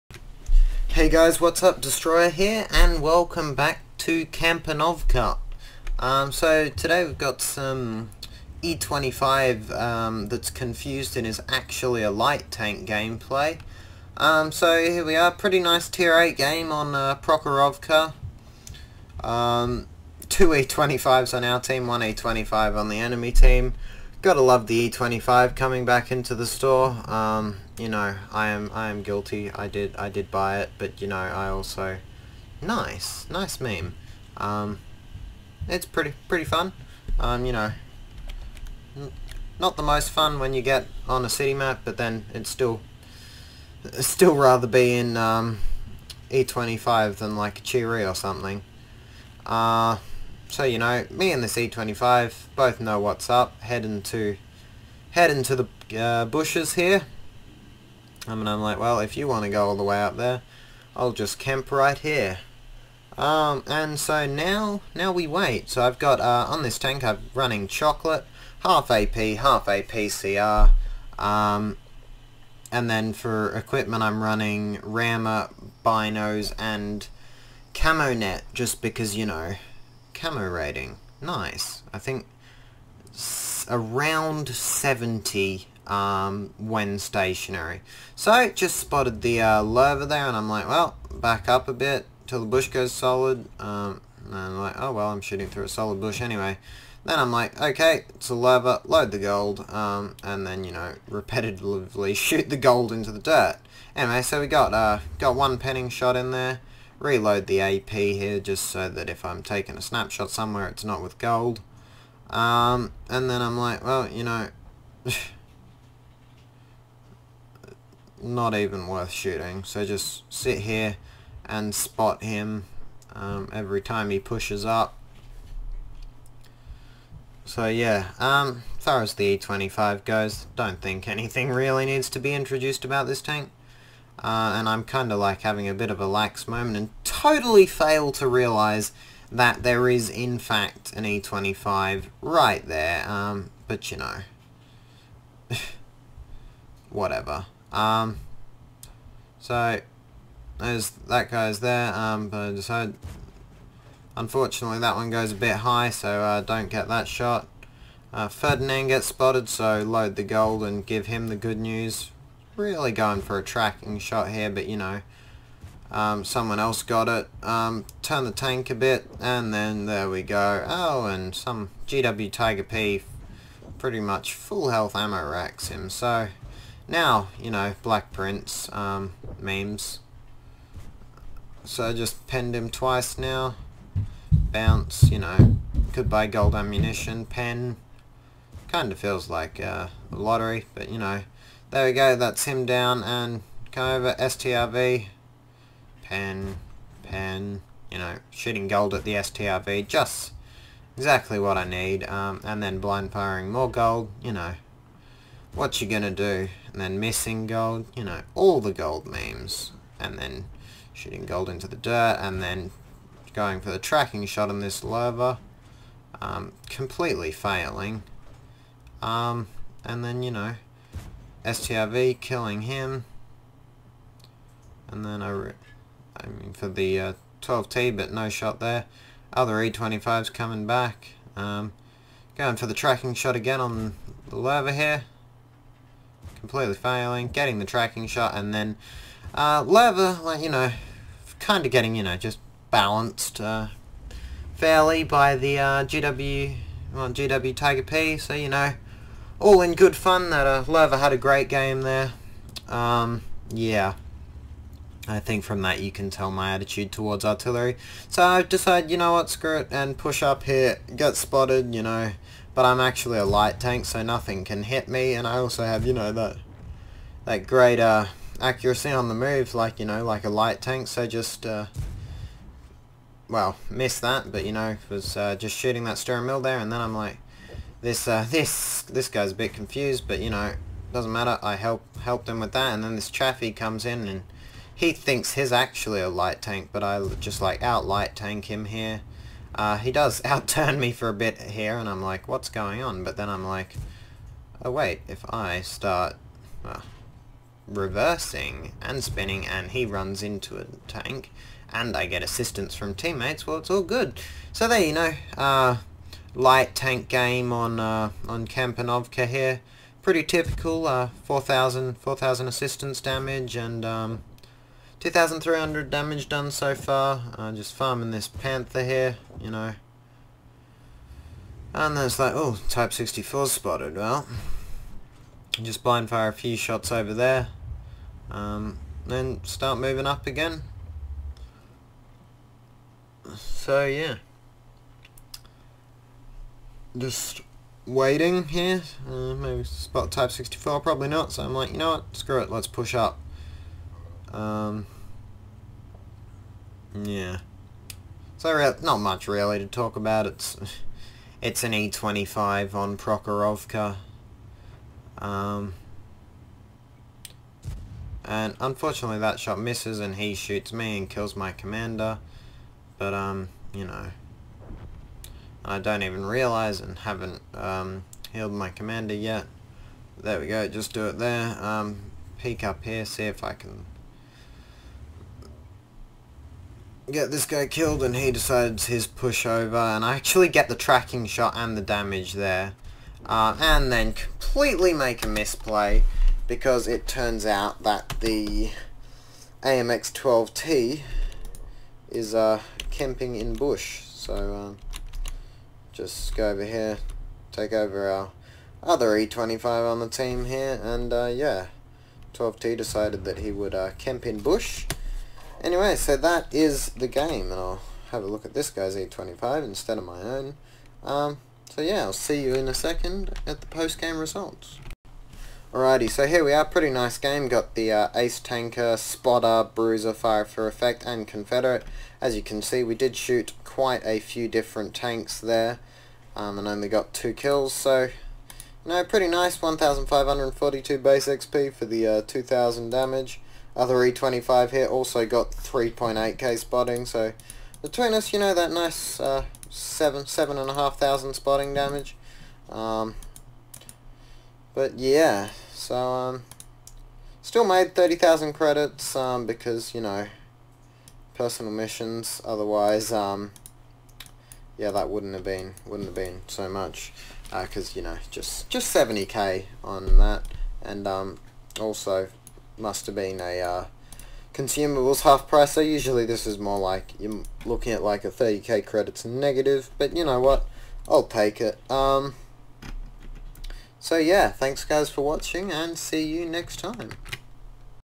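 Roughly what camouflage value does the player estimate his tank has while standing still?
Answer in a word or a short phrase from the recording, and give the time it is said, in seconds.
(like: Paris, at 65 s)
70, at 84 s.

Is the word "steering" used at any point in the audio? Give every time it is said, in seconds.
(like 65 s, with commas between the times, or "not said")
275 s.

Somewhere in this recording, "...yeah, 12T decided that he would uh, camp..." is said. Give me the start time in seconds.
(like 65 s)
401 s.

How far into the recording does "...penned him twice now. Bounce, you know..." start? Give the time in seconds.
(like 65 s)
182 s.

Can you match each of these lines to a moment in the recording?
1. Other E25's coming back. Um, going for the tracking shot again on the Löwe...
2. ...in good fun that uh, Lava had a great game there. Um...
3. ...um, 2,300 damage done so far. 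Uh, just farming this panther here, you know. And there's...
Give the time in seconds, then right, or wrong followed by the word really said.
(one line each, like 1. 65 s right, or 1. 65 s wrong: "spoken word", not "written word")
1. 229 s right
2. 249 s right
3. 313 s right.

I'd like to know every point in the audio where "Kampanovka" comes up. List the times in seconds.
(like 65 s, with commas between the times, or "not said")
4 s, 308 s.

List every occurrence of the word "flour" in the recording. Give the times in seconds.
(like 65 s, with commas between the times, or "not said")
not said.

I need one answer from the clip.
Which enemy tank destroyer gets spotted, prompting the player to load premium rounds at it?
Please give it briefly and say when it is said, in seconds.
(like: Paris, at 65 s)
Ferdinand, at 158 s.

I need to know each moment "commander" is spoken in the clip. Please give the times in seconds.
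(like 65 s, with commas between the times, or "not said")
361 s, 368 s.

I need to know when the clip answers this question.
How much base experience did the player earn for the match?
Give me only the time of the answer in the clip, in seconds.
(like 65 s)
429 s.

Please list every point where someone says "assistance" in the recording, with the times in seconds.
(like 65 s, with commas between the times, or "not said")
302 s, 312 s.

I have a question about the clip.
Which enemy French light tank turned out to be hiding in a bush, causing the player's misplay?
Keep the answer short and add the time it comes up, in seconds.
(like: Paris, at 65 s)
AMX-12T, at 389 s.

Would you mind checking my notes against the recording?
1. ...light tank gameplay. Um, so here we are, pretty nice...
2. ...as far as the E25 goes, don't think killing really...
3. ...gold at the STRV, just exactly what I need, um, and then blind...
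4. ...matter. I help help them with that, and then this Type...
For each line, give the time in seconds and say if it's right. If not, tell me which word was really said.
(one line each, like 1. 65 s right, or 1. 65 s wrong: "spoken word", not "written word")
1. 12 s right
2. 128 s wrong: "anything", not "killing"
3. 198 s right
4. 281 s wrong: "Chaffee", not "Type".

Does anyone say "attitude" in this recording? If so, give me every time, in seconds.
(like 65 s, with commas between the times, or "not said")
256 s.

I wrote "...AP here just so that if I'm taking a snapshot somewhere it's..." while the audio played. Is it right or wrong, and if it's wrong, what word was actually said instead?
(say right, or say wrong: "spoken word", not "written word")
right.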